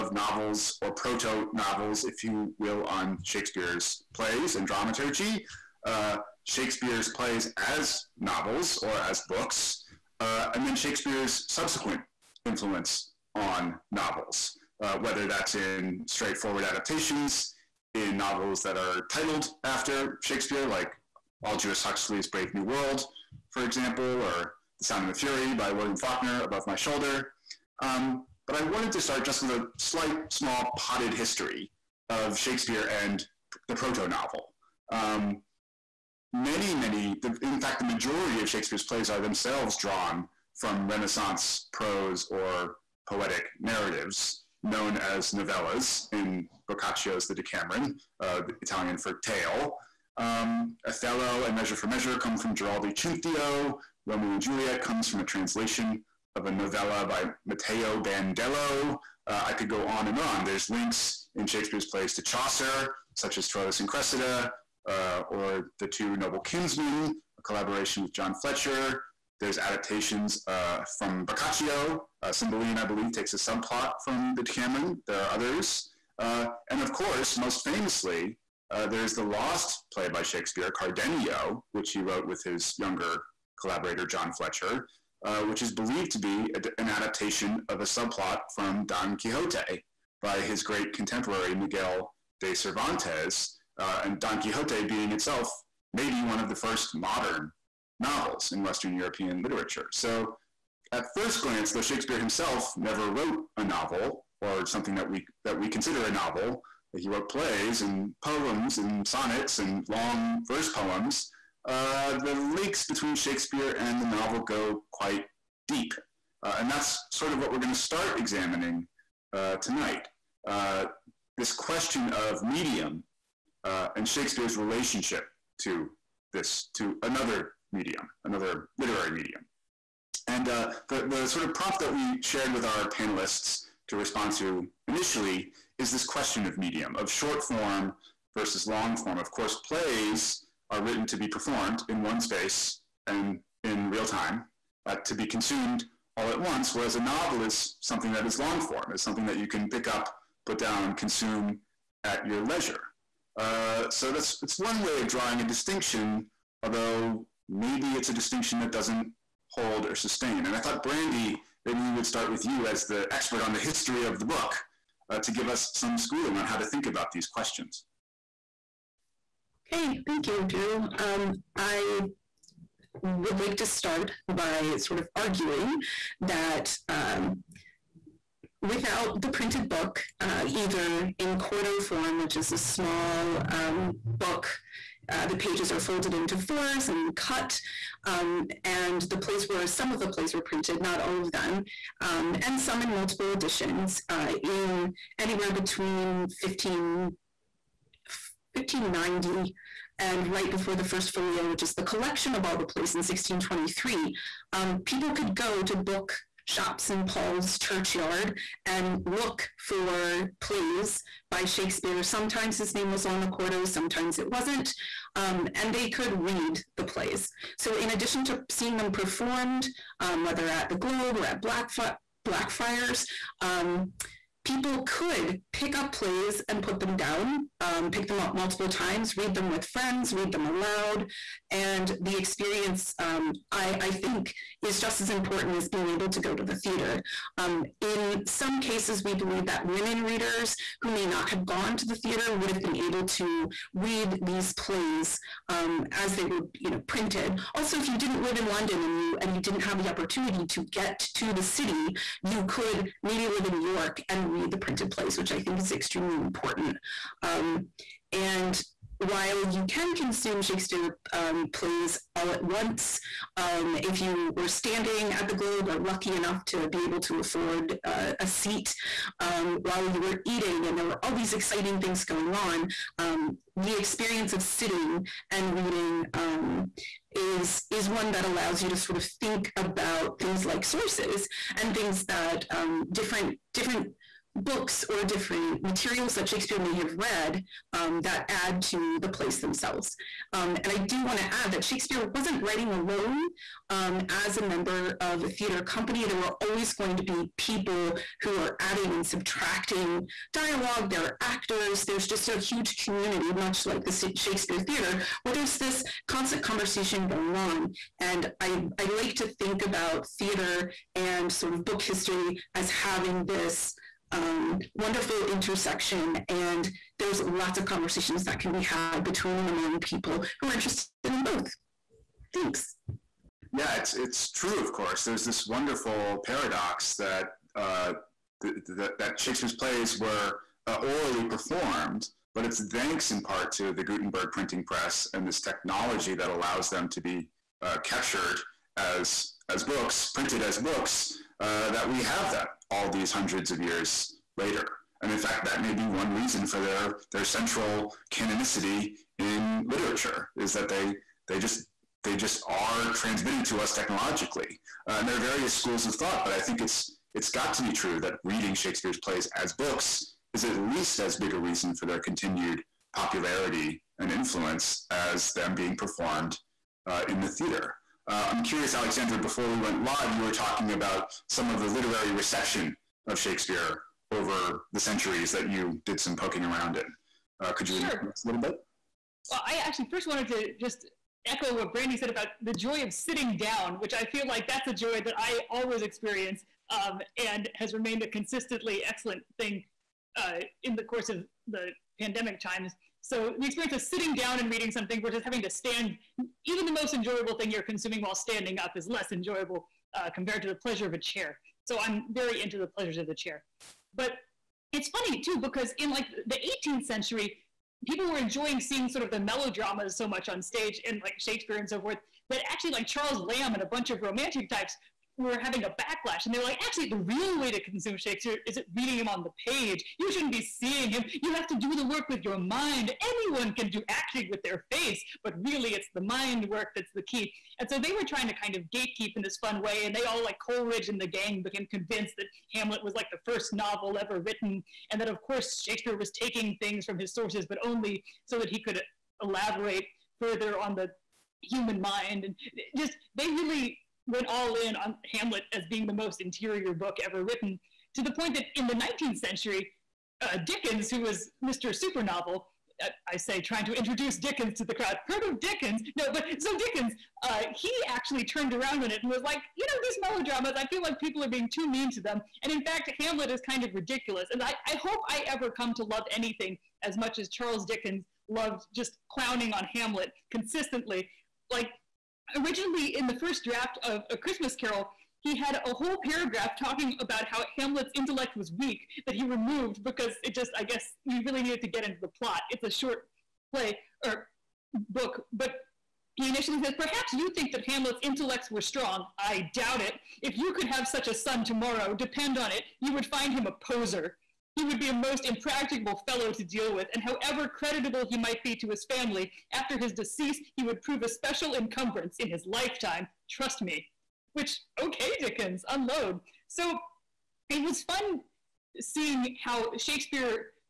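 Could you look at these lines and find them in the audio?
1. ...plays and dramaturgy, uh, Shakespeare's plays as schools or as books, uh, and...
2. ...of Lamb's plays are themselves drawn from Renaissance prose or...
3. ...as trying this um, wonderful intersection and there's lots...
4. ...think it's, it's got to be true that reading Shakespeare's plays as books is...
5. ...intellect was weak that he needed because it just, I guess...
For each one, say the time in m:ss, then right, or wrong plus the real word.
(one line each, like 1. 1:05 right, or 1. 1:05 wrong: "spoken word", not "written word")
1. 0:04 wrong: "novels", not "schools"
2. 0:38 wrong: "Shakespeare", not "Lamb"
3. 5:12 wrong: "having", not "trying"
4. 5:56 right
5. 7:57 wrong: "removed", not "needed".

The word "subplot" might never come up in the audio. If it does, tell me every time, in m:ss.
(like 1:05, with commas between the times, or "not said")
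1:13, 1:27.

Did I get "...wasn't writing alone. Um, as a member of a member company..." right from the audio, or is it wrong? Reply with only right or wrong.
wrong.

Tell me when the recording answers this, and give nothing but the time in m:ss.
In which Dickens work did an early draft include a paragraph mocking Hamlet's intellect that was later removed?
7:54.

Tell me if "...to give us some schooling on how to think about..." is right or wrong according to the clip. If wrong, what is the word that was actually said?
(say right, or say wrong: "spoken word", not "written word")
right.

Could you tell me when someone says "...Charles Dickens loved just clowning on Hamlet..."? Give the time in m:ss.
7:47.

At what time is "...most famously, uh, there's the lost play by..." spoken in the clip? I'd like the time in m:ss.
1:17.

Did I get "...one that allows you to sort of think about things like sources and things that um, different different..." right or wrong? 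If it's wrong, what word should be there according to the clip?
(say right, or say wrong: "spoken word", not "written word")
right.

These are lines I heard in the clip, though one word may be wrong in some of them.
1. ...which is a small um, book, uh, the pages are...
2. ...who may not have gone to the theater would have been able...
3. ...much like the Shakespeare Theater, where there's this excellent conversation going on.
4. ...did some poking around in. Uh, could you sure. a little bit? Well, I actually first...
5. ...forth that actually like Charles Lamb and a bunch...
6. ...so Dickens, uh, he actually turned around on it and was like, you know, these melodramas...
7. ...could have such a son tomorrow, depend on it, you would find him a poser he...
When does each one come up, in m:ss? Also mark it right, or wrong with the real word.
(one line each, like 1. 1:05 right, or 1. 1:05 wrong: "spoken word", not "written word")
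1. 3:02 right
2. 4:00 right
3. 5:03 wrong: "constant", not "excellent"
4. 6:15 right
5. 6:51 right
6. 7:36 right
7. 8:10 right.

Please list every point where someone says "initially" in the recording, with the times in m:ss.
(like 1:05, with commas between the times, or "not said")
2:14, 8:06.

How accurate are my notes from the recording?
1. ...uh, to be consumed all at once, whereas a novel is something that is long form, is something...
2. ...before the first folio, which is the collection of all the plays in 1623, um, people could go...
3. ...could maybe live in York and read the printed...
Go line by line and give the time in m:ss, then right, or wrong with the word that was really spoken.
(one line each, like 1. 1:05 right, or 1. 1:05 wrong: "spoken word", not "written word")
1. 2:24 right
2. 3:20 right
3. 4:12 right.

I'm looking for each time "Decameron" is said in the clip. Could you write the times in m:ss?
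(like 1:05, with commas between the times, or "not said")
0:47, 1:14.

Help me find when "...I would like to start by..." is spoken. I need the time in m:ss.
2:51.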